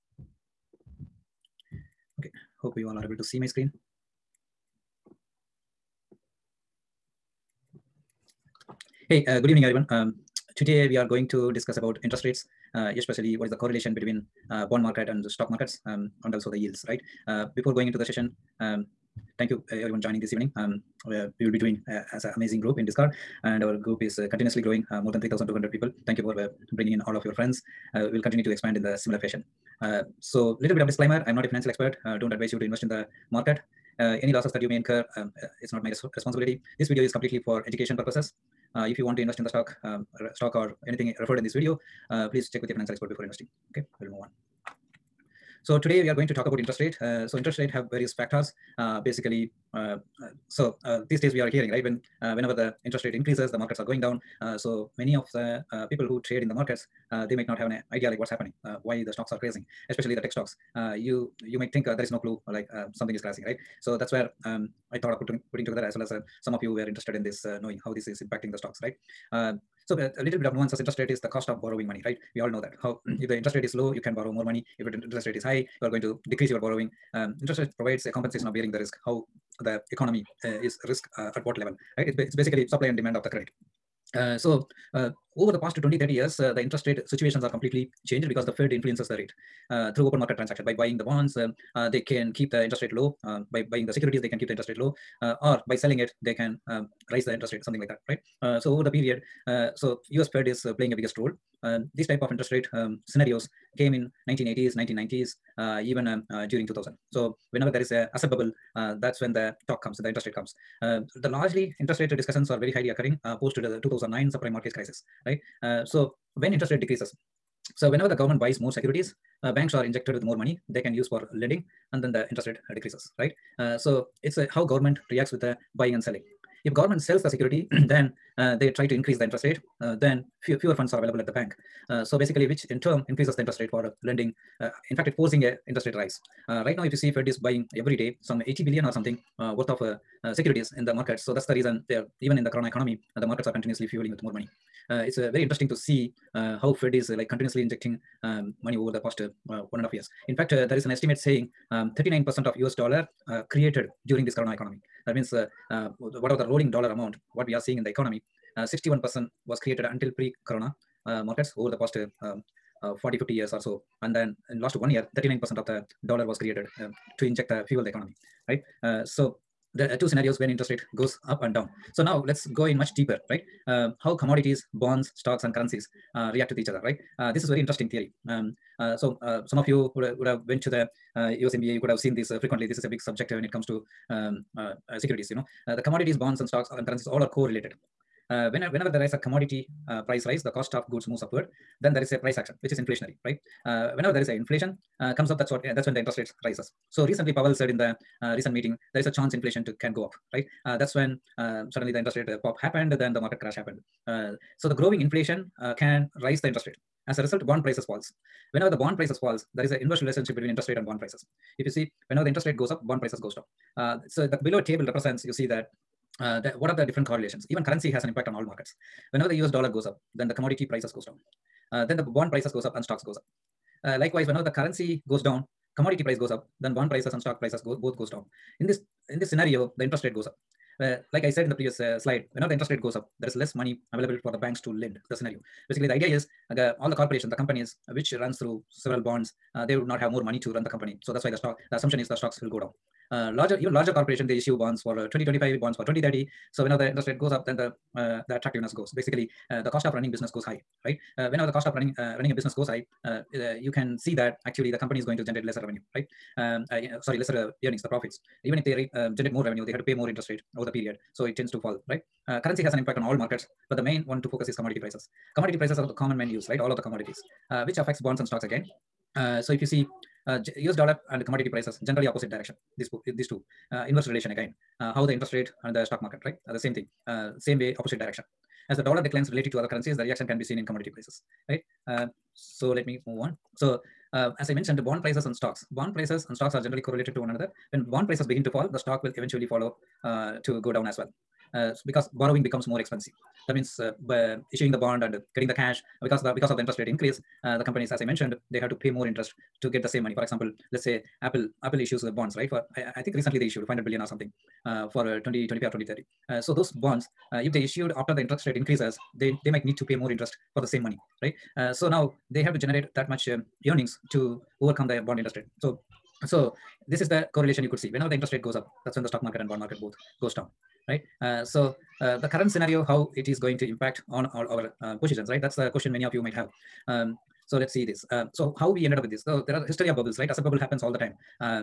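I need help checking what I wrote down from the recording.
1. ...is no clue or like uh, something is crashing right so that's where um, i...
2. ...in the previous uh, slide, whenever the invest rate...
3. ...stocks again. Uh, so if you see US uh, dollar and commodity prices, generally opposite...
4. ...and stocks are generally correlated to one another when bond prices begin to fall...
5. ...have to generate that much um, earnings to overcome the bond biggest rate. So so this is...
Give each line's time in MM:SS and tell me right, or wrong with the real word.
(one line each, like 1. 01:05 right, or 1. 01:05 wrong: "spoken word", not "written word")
1. 01:02 right
2. 03:51 wrong: "interest", not "invest"
3. 04:28 right
4. 04:46 right
5. 05:12 wrong: "interest", not "biggest".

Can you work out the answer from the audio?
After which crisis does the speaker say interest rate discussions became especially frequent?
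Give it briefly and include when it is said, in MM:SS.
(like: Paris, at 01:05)
2009 subprime mortgage crisis, at 01:53.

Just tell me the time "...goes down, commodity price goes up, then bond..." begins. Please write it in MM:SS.
03:45.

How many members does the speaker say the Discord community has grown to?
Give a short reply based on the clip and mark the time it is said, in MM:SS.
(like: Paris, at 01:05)
more than 3200, at 00:25.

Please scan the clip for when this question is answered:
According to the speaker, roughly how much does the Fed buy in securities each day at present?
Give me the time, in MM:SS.
02:18.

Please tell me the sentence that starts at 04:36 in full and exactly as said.
Are uh, the same thing, uh, same way, opposite direction.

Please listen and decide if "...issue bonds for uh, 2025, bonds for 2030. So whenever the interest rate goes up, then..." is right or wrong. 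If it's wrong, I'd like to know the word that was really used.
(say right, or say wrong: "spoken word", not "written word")
right.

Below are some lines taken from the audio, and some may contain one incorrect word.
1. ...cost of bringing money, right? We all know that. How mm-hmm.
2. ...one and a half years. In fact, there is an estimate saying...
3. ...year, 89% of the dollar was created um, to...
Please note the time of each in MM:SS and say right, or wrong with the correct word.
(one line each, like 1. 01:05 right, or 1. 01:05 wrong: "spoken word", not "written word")
1. 01:11 wrong: "borrowing", not "bringing"
2. 02:29 right
3. 02:44 wrong: "39", not "89".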